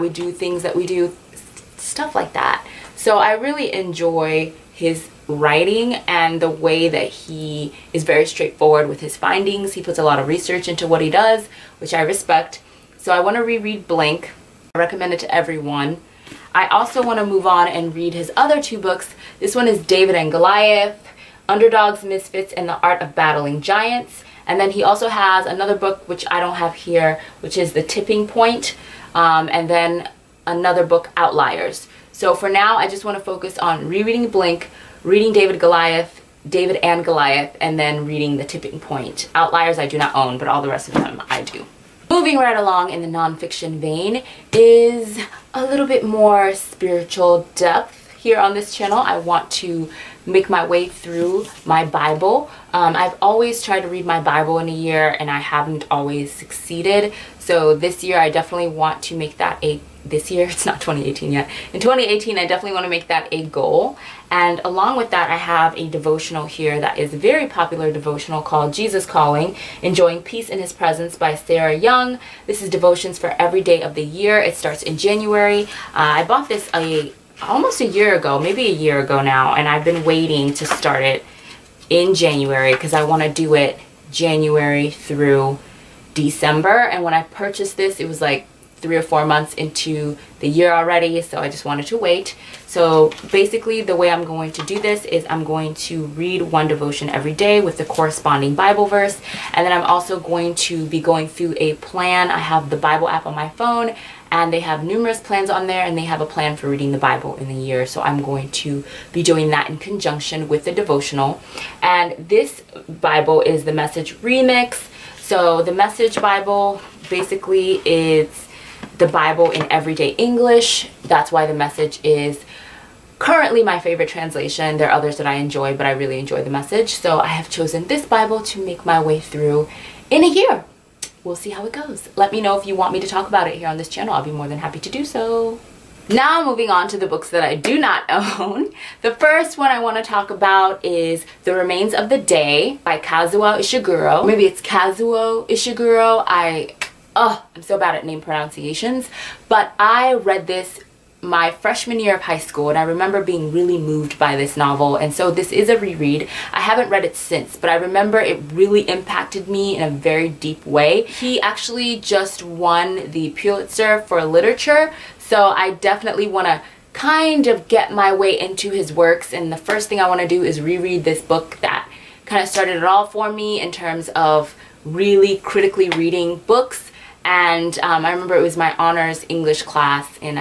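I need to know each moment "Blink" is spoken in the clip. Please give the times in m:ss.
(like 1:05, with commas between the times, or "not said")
0:13, 0:34.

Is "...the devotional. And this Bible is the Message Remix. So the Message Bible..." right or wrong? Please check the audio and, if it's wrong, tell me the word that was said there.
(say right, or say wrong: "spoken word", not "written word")
right.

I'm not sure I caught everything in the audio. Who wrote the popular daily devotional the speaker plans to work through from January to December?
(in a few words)
Sarah Young.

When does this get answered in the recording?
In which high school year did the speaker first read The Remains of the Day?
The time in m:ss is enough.
2:31.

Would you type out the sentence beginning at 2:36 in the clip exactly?
I haven't read it since but I remember it really impacted me in a very deep way.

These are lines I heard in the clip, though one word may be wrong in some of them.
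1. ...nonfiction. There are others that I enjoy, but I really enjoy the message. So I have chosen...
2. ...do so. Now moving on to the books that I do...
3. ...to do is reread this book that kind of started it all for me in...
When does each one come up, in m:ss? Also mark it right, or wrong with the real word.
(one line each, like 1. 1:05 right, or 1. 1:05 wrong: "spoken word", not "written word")
1. 2:04 wrong: "translation", not "nonfiction"
2. 2:14 right
3. 2:50 right.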